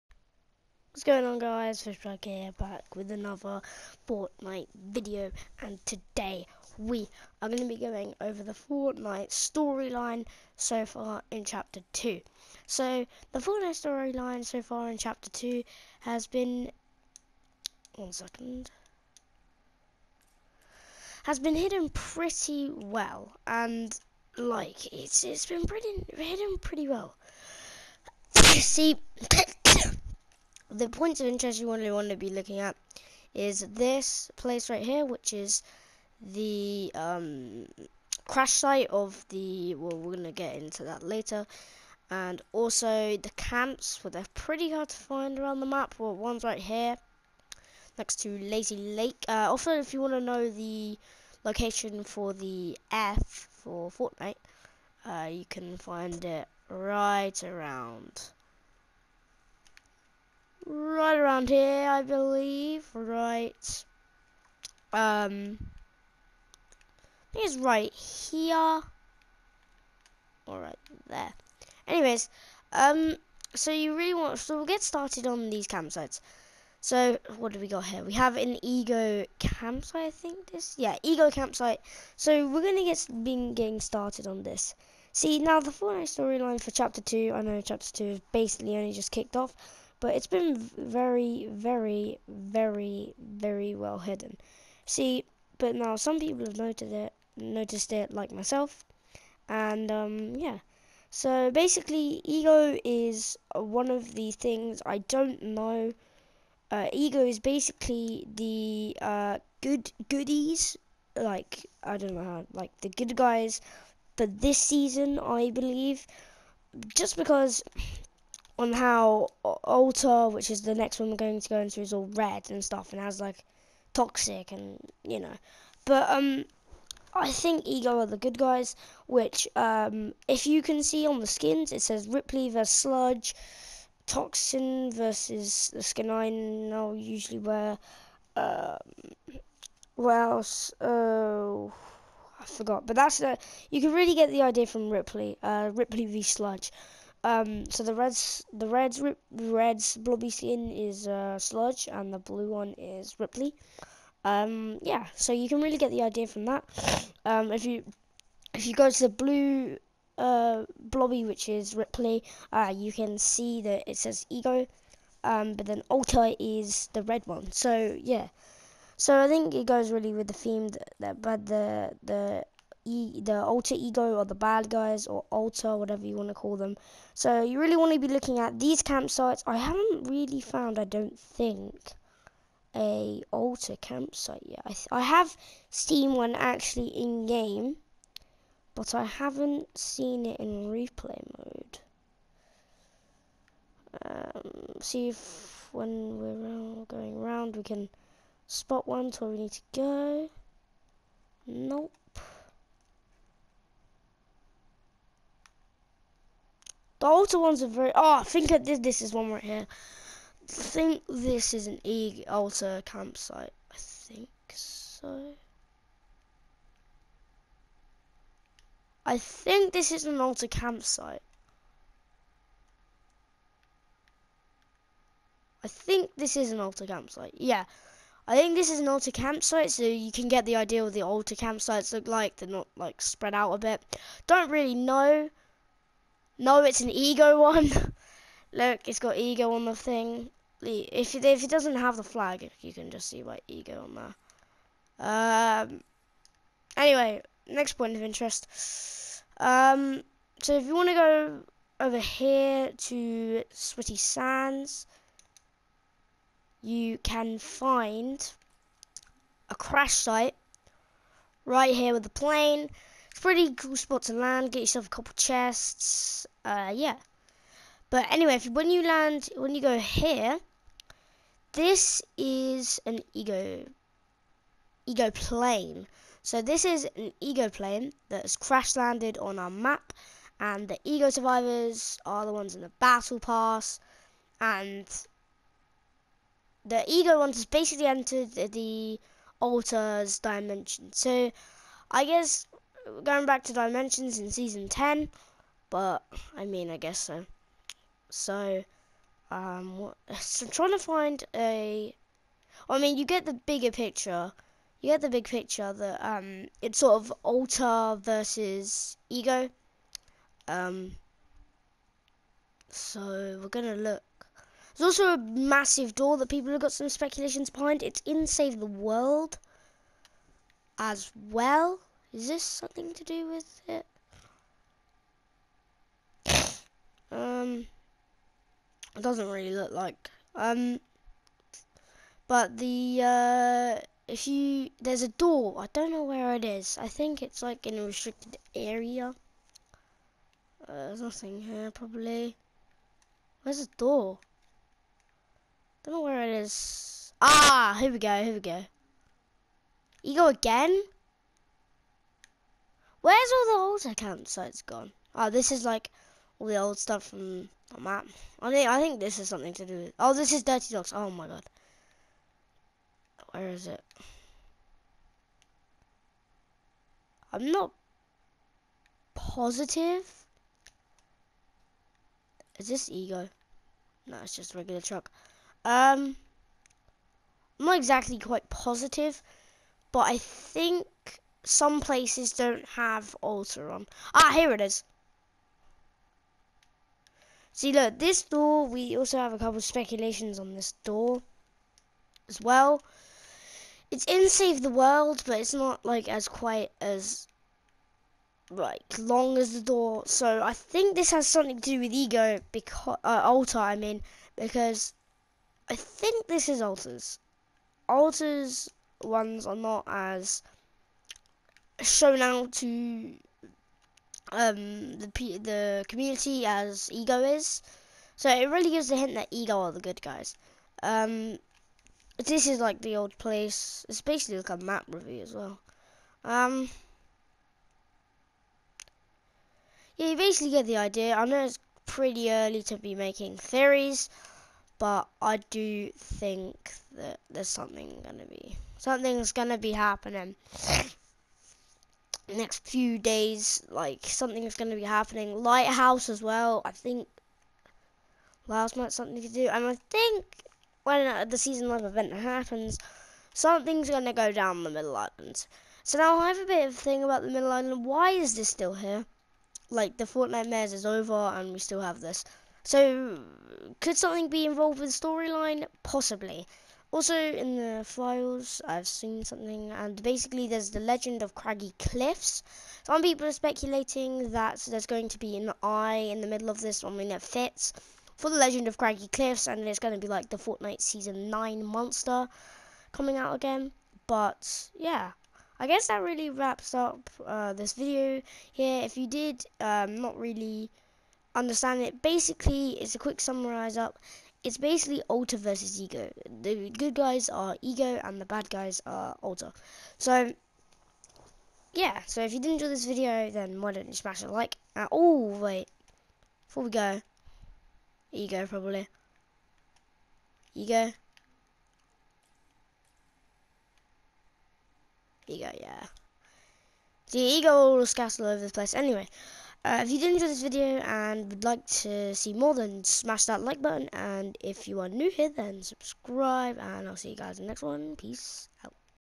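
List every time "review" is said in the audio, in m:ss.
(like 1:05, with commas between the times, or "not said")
7:04.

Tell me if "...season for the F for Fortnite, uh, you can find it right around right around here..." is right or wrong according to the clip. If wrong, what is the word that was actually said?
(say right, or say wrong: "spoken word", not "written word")
wrong: "location", not "season".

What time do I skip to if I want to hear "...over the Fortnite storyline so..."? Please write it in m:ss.
0:08.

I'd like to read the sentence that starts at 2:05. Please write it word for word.
But um, I think Ego are the good guys.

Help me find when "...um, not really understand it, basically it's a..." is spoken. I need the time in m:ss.
8:09.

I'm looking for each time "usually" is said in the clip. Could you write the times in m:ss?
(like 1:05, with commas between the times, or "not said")
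2:16.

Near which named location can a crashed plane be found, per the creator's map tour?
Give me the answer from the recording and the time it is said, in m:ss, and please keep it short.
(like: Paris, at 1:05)
Sweaty Sands, at 4:13.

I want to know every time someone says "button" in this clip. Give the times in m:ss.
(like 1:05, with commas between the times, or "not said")
8:43.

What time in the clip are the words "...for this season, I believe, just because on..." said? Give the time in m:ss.
1:54.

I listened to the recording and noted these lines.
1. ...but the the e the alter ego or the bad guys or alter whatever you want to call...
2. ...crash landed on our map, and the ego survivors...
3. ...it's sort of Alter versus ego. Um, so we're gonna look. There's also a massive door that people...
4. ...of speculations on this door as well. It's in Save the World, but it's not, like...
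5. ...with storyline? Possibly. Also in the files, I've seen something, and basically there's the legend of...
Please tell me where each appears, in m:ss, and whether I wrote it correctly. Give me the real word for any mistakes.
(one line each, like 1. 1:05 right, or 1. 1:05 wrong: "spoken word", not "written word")
1. 2:51 right
2. 4:38 right
3. 5:06 right
4. 6:29 right
5. 7:44 right.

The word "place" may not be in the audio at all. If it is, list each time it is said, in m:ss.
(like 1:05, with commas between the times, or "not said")
0:34, 6:21, 7:03, 8:38.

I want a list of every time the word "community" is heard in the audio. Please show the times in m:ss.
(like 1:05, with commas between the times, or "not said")
6:55.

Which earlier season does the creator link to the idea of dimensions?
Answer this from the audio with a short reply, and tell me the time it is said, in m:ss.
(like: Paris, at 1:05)
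Season 10, at 4:54.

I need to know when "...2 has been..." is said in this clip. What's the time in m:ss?
0:15.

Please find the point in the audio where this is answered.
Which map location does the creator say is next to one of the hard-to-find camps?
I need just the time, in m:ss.
0:48.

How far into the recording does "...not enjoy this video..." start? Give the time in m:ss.
8:22.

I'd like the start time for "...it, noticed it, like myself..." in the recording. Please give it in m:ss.
1:36.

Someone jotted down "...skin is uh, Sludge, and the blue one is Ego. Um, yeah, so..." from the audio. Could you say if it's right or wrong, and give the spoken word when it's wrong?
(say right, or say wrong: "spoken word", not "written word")
wrong: "Rippley", not "Ego".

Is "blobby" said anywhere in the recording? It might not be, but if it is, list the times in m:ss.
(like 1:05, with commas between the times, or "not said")
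2:29, 2:40.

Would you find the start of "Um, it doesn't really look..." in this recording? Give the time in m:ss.
5:27.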